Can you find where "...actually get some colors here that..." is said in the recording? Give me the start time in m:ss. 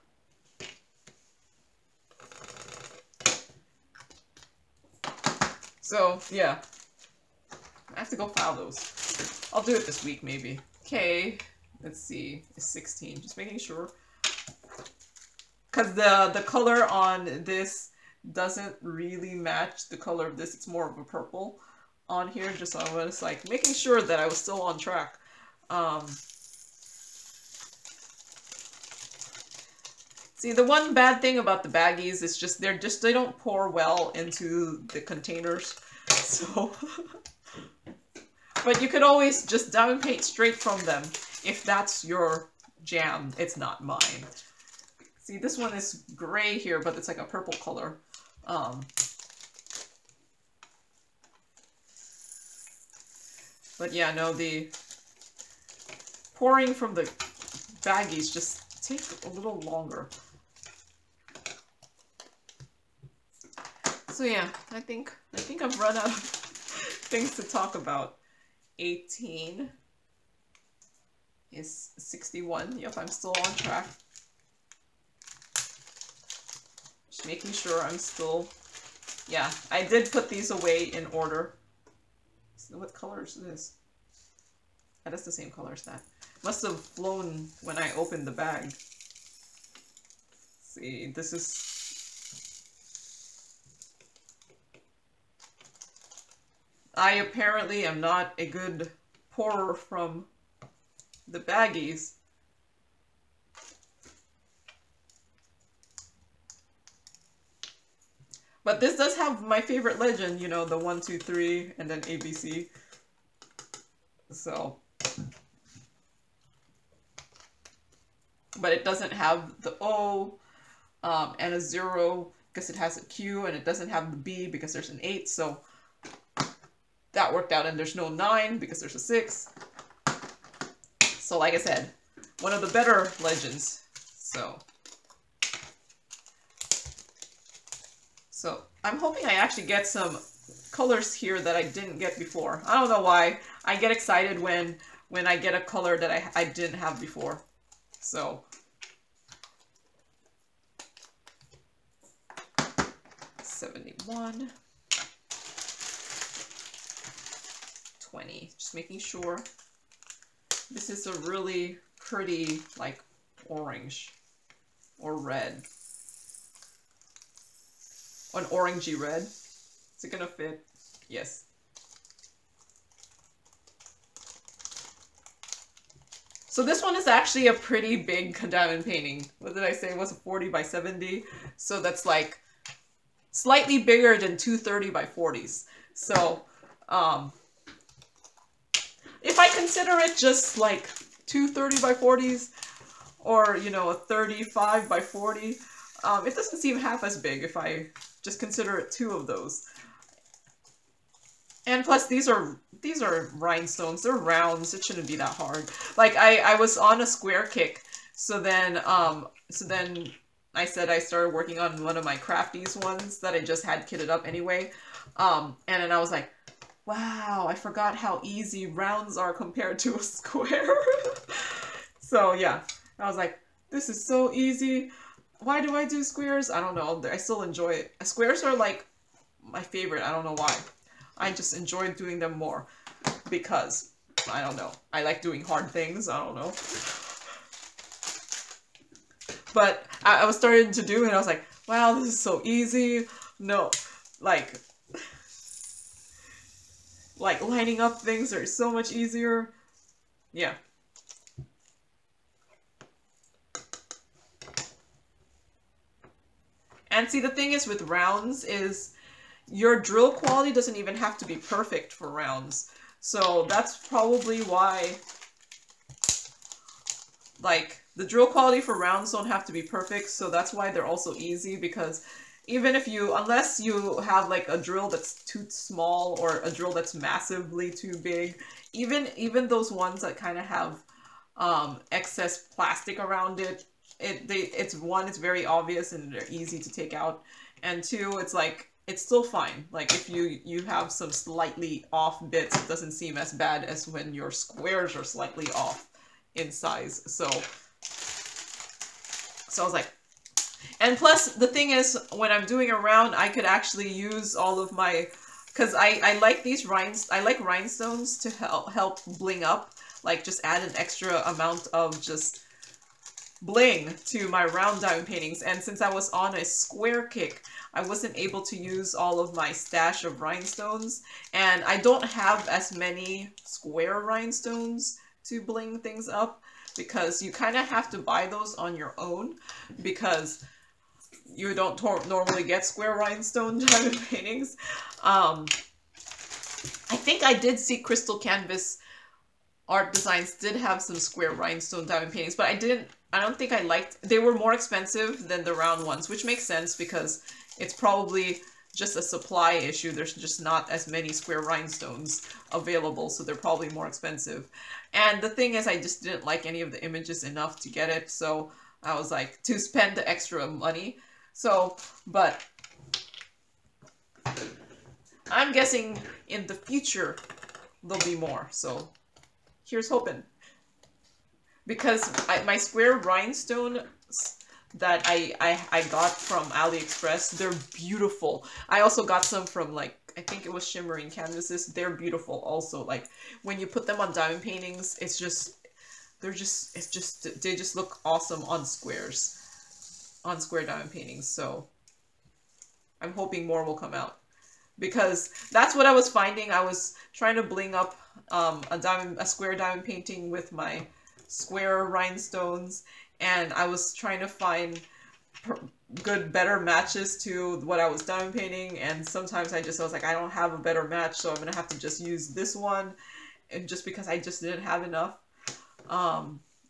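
2:19.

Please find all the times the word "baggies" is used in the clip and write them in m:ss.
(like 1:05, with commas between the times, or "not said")
0:31, 0:57, 1:41.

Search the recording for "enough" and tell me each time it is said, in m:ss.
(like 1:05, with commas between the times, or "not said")
5:57, 6:54.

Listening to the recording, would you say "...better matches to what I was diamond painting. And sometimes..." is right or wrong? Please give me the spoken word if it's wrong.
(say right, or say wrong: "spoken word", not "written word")
right.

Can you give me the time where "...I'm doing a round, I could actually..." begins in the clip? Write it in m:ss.
5:02.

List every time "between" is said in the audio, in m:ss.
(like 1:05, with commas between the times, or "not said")
not said.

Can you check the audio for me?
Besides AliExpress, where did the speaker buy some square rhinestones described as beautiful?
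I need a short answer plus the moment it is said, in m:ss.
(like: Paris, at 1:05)
Shimmering Canvases, at 6:20.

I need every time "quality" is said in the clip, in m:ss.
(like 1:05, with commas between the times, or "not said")
4:20, 4:28.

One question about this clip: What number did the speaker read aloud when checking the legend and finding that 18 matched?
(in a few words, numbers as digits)
61.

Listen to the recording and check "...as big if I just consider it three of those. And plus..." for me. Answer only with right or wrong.
wrong.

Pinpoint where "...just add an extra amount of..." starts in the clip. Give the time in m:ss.
5:10.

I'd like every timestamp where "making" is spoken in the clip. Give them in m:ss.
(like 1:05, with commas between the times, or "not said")
0:13, 0:23, 1:17, 2:38.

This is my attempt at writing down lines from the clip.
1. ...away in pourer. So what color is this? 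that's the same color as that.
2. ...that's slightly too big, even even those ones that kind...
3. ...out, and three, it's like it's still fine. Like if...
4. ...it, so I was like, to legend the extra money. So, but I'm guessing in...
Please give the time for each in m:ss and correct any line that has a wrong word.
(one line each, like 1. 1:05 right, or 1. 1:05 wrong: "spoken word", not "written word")
1. 1:20 wrong: "order", not "pourer"
2. 4:36 wrong: "massively", not "slightly"
3. 4:46 wrong: "two", not "three"
4. 5:57 wrong: "spend", not "legend".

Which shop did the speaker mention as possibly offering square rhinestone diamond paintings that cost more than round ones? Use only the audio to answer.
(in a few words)
Crystal Canvas Art Designs.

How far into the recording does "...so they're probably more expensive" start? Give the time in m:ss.
5:53.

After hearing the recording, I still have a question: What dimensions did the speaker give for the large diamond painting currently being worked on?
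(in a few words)
40 by 70.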